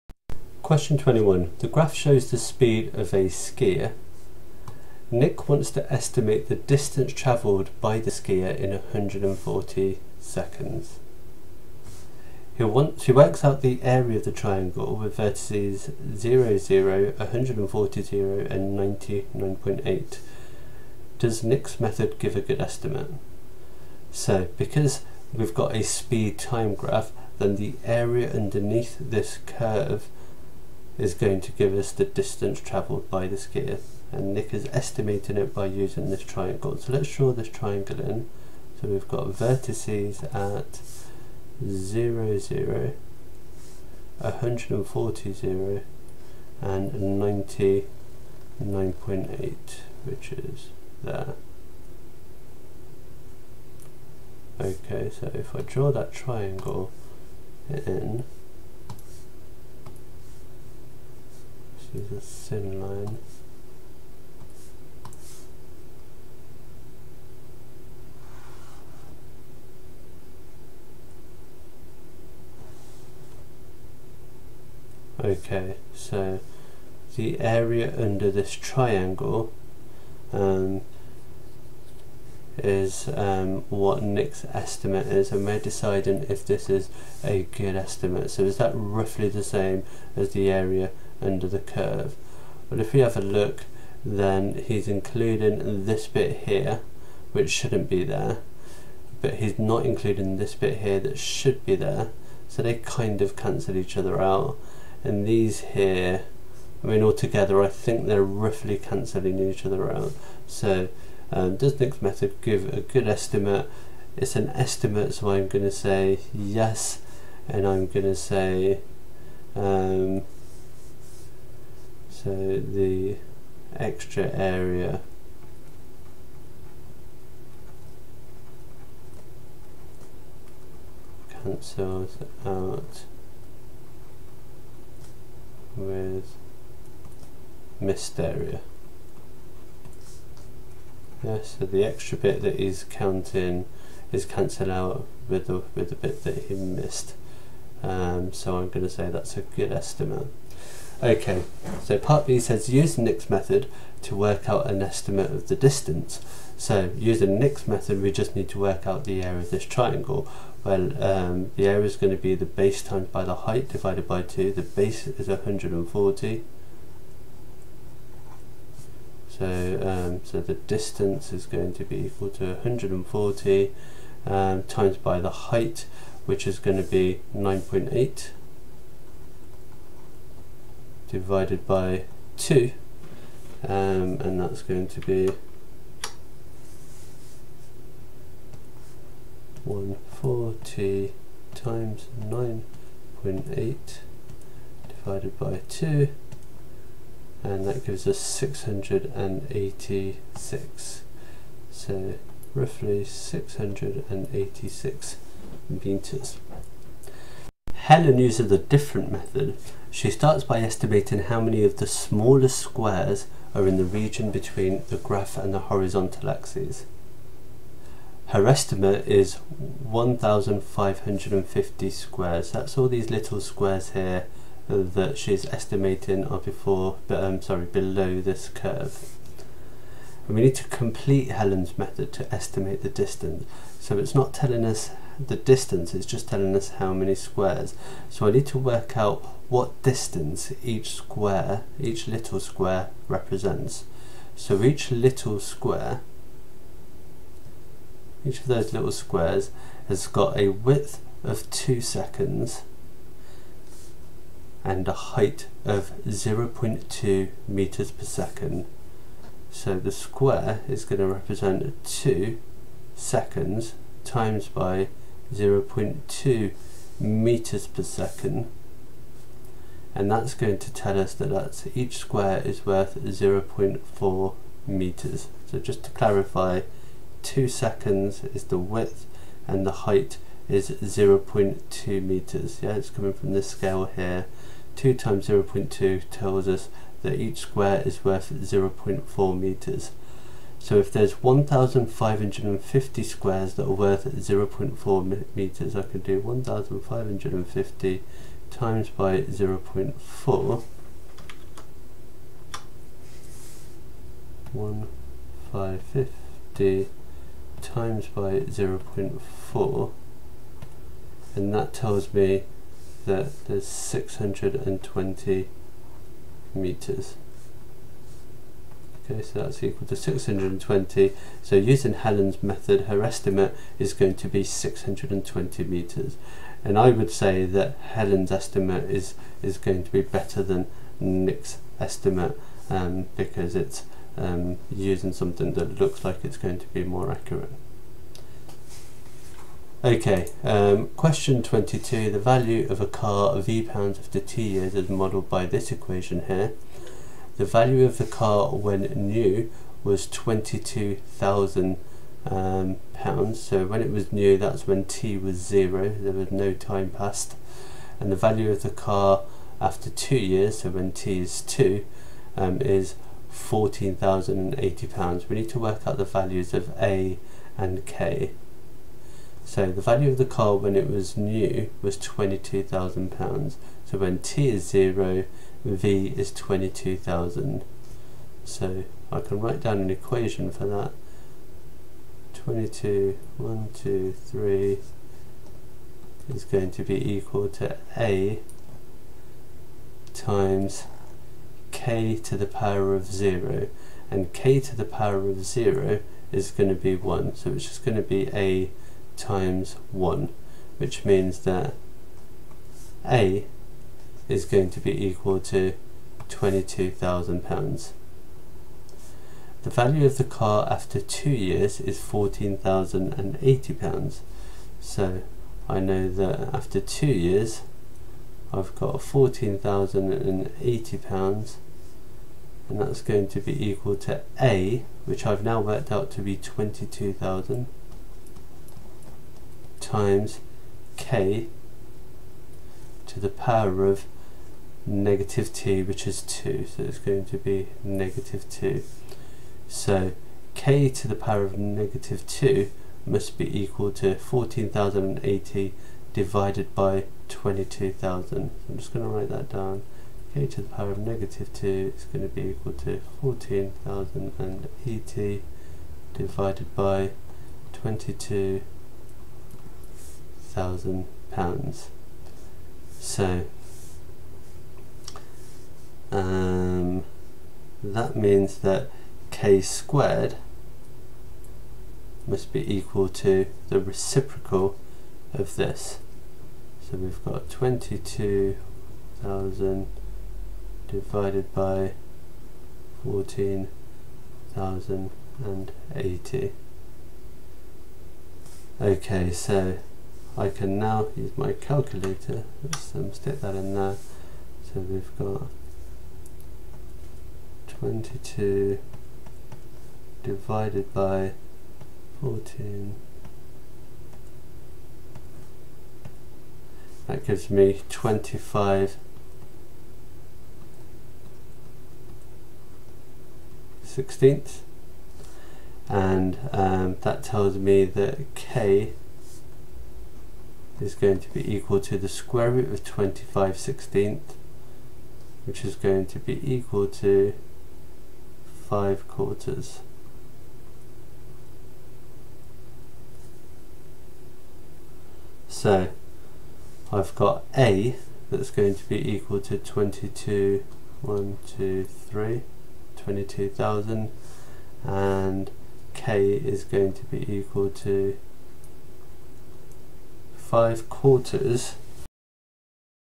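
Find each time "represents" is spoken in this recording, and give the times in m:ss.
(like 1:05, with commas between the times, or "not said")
4:03, 4:21.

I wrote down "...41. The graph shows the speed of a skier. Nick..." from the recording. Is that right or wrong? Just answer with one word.
wrong.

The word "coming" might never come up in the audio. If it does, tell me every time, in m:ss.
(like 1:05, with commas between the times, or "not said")
4:42.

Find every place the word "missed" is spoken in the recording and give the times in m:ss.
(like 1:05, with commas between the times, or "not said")
2:17, 2:26.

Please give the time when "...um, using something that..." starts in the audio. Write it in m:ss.
5:34.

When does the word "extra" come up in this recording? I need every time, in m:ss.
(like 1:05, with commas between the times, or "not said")
2:03, 2:21.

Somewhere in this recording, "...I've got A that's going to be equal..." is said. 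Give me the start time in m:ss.
8:56.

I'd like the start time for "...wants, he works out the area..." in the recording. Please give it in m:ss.
0:12.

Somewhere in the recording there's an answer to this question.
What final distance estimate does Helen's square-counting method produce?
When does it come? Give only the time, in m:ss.
5:24.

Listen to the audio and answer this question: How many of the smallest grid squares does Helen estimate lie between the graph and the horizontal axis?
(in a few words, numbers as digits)
1,550.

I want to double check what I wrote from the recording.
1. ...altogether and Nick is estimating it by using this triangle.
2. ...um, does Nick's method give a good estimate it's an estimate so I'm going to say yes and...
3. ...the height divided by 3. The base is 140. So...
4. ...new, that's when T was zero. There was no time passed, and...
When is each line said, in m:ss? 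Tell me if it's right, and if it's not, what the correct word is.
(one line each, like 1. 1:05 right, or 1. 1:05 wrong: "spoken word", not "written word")
1. 0:33 wrong: "skier", not "altogether"
2. 1:51 right
3. 2:43 wrong: "2", not "3"
4. 5:54 right.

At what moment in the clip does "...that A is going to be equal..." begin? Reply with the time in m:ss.
6:41.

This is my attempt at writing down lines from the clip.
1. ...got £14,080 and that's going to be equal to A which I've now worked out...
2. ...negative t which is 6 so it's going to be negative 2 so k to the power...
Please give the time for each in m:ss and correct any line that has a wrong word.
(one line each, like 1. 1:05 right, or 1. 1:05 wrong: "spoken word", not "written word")
1. 6:58 right
2. 7:14 wrong: "2", not "6".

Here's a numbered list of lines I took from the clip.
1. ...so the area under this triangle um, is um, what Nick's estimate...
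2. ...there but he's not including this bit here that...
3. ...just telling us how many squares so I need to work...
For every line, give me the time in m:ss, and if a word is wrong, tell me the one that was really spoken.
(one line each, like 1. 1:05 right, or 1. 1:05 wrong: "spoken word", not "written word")
1. 1:15 right
2. 1:38 right
3. 3:56 right.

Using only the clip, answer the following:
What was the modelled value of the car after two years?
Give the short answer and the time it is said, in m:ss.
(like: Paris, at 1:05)
£14,080, at 6:03.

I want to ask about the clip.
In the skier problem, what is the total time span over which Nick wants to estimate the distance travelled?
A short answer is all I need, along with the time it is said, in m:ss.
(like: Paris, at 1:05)
140 seconds, at 0:08.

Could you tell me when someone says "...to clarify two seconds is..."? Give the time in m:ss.
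4:35.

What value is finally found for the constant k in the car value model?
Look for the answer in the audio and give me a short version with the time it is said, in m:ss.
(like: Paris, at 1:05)
5/4, at 9:10.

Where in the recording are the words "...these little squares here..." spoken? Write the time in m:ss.
3:42.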